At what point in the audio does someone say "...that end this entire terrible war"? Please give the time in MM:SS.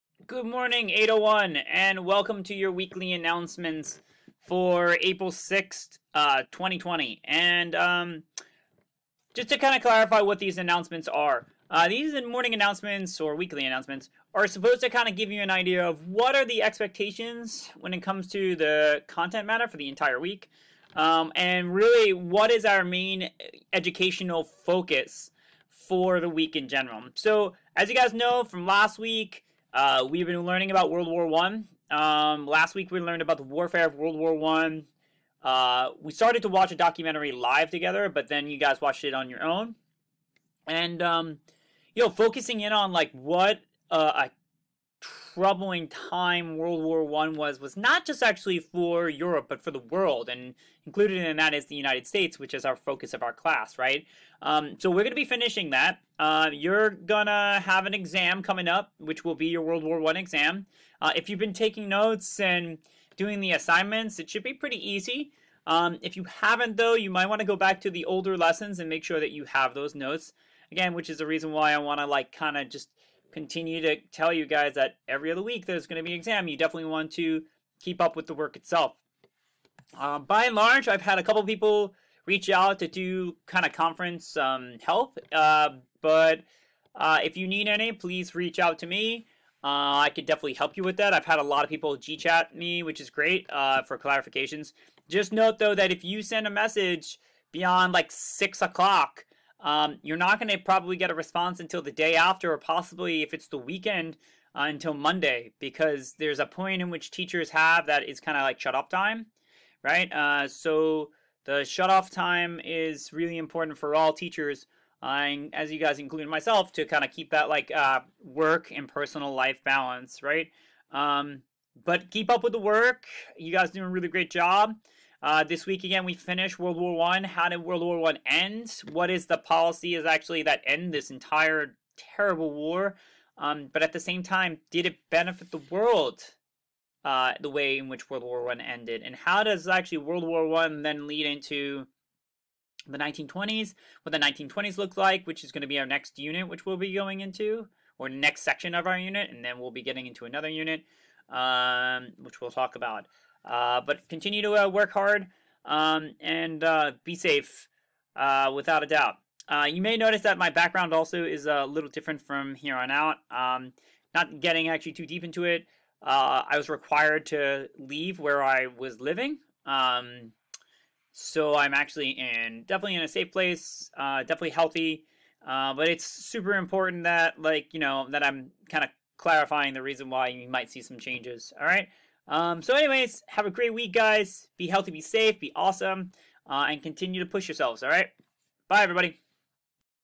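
02:10.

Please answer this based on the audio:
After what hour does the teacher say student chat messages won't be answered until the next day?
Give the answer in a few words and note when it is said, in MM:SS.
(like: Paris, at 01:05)
6 o'clock, at 01:38.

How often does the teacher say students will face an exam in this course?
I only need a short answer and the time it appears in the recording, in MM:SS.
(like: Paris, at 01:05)
every other week, at 01:15.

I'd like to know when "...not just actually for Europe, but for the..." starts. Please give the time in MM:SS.
00:47.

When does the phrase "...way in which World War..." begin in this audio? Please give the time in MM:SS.
02:17.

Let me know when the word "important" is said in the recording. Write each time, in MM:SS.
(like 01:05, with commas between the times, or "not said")
01:53, 02:56.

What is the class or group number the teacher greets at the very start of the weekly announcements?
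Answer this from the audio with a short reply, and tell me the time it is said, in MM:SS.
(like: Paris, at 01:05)
801, at 00:00.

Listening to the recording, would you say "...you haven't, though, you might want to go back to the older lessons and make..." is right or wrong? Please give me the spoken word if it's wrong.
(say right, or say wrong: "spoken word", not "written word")
right.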